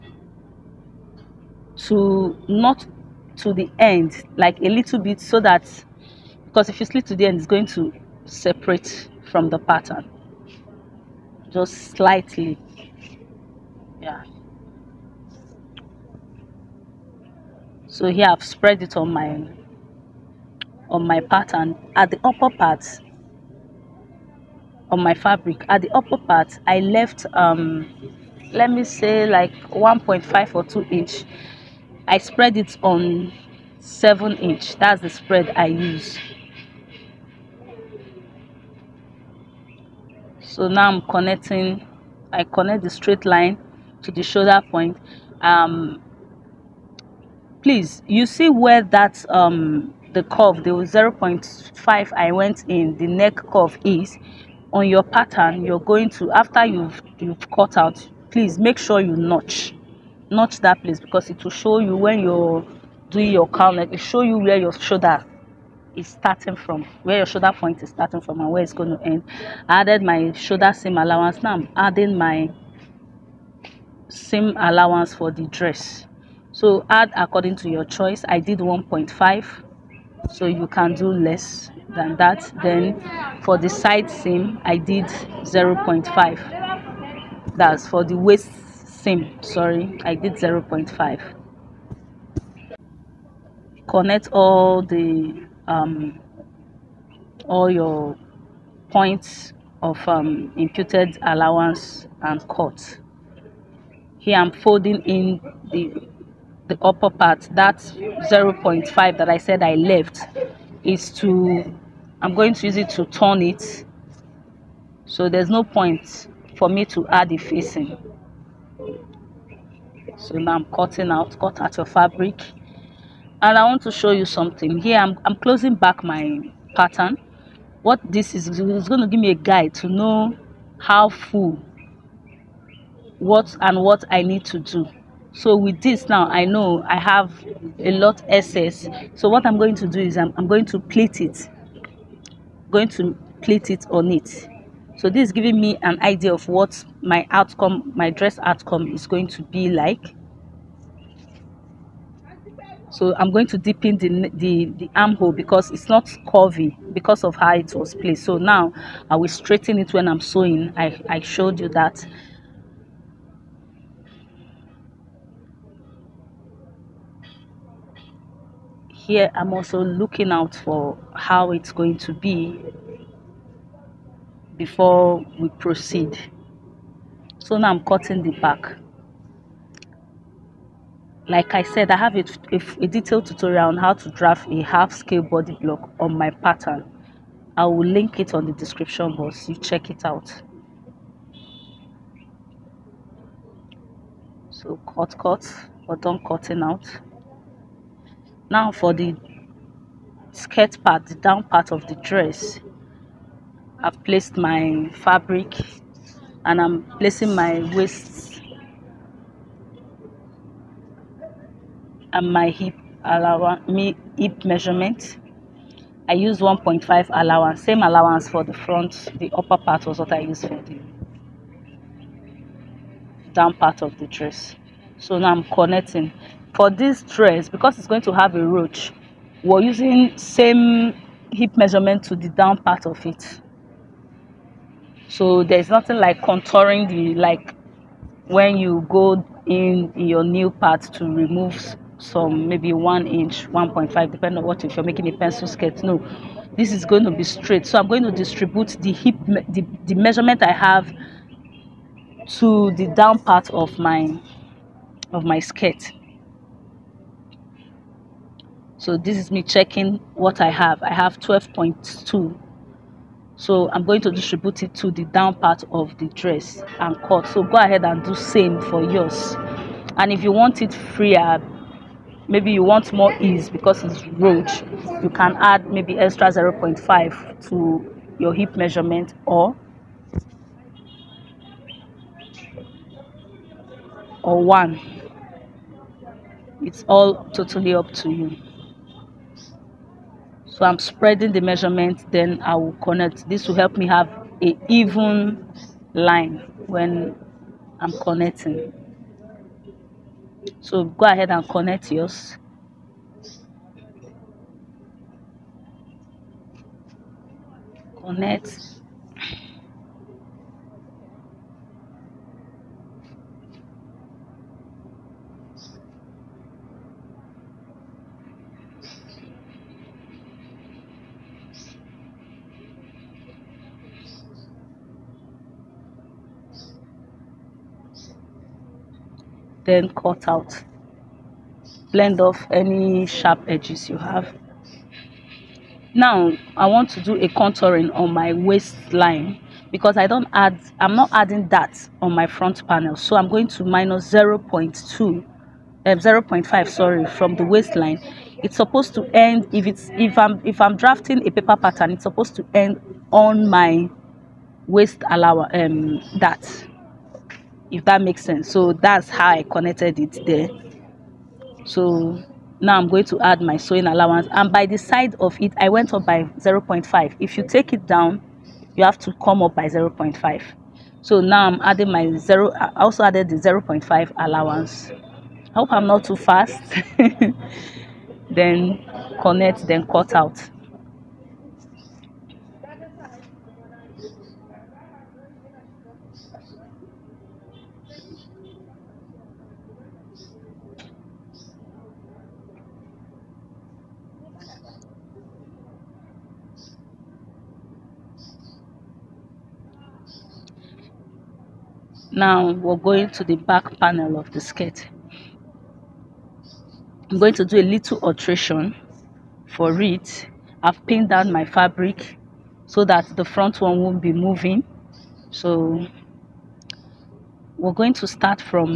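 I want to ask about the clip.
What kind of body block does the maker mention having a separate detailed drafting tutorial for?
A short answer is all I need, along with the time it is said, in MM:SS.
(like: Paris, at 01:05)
half scale body block, at 03:04.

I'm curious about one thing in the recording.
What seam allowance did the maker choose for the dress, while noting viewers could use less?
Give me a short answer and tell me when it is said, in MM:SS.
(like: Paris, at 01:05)
1.5, at 01:18.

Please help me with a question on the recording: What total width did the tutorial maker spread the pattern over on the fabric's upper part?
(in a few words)
7 inch.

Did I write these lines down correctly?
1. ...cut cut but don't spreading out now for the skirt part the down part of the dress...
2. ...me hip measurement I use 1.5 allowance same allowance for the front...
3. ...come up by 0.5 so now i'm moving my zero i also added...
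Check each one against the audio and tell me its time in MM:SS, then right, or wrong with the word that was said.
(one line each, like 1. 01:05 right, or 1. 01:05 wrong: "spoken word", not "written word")
1. 03:14 wrong: "cutting", not "spreading"
2. 03:33 right
3. 06:09 wrong: "adding", not "moving".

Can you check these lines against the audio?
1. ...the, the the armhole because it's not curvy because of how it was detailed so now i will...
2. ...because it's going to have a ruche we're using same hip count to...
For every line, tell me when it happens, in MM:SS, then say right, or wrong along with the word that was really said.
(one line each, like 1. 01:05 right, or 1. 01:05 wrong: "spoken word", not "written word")
1. 02:33 wrong: "placed", not "detailed"
2. 03:47 wrong: "measurement", not "count".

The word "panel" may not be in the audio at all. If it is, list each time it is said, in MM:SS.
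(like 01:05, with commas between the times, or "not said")
05:42, 06:43.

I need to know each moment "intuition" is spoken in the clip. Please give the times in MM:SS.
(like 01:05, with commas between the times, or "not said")
not said.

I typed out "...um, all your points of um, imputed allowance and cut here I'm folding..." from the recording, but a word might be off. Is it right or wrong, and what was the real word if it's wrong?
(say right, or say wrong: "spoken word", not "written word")
right.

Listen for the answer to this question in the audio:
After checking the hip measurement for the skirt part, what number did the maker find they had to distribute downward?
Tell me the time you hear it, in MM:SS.
04:21.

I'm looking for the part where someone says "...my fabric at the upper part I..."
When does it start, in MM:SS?
00:25.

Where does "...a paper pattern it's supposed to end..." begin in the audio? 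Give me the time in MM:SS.
05:51.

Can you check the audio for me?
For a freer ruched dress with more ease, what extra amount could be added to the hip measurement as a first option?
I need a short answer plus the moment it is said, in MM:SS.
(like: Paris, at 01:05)
0.5, at 04:35.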